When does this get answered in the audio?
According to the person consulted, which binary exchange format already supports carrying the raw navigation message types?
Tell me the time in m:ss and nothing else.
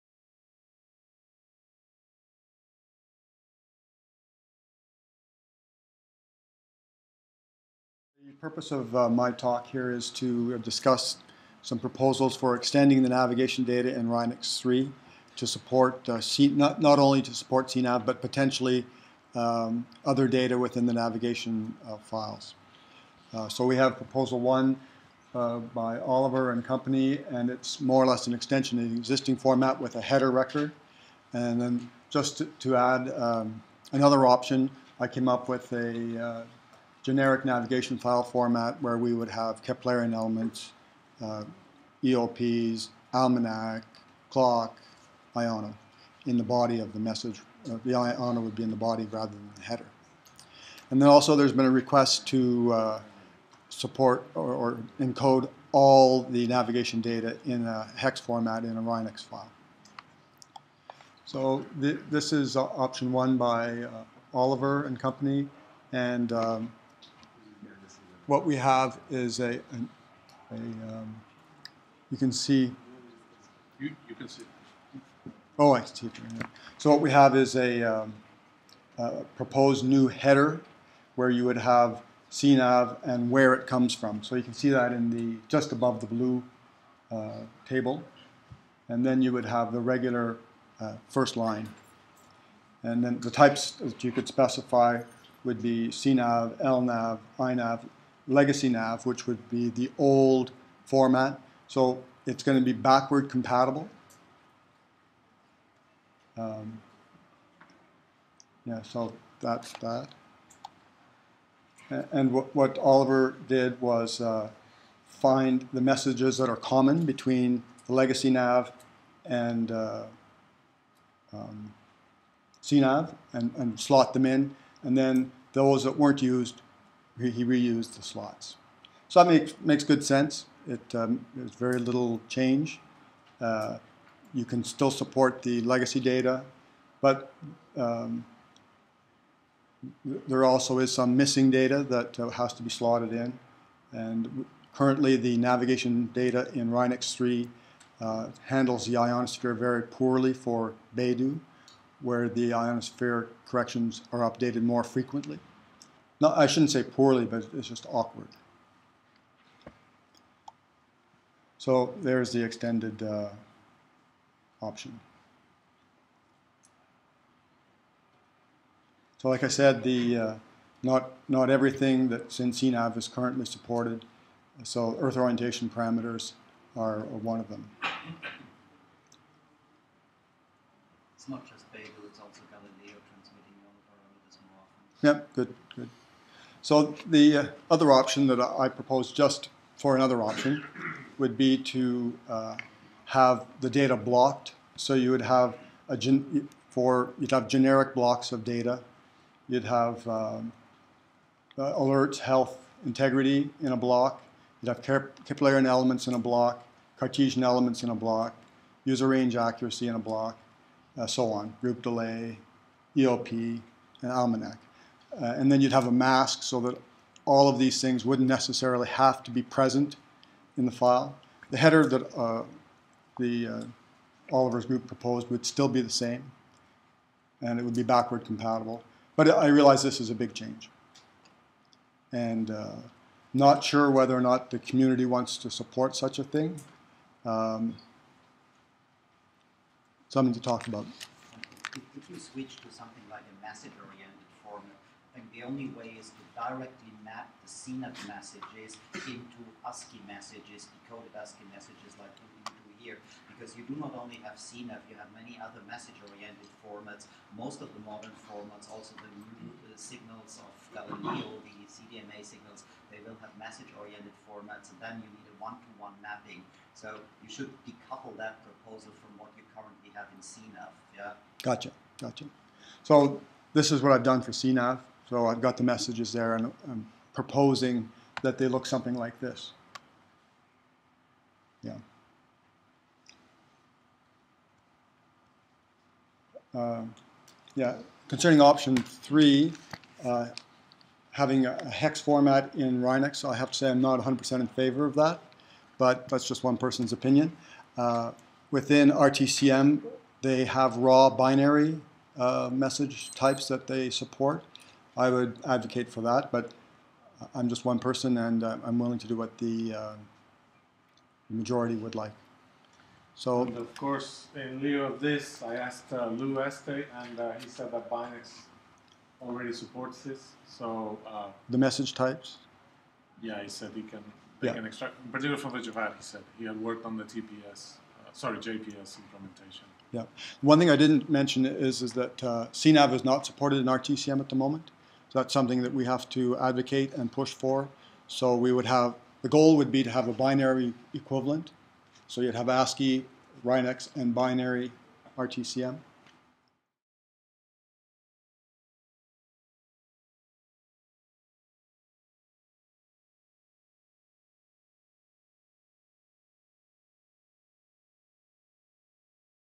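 5:17.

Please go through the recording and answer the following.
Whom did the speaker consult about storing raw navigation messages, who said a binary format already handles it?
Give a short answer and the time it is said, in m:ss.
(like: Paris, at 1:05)
Lou Estey, at 5:16.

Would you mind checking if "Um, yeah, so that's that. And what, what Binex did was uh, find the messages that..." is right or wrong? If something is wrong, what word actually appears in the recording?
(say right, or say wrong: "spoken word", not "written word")
wrong: "Oliver", not "Binex".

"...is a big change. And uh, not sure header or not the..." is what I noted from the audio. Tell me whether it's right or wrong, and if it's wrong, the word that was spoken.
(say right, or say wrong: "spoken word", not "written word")
wrong: "whether", not "header".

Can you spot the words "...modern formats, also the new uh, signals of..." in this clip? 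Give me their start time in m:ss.
4:17.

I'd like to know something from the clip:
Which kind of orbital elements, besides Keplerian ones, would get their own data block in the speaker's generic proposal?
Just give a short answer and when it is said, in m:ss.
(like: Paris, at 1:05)
Cartesian elements, at 3:26.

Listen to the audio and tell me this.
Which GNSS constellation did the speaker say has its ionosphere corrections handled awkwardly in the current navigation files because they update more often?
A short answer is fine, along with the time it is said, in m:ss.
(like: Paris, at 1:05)
Beidou, at 2:30.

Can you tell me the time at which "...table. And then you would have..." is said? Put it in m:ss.
1:27.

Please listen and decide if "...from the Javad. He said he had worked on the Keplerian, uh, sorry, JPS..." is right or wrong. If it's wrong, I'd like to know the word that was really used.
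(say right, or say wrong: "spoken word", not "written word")
wrong: "TPS", not "Keplerian".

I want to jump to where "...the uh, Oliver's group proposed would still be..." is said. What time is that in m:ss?
3:43.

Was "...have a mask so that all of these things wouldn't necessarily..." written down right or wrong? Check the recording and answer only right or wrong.
right.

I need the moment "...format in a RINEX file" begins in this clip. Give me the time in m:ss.
0:58.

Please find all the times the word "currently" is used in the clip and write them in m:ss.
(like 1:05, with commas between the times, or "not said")
2:24, 2:53, 4:29.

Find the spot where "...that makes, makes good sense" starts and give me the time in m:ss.
2:09.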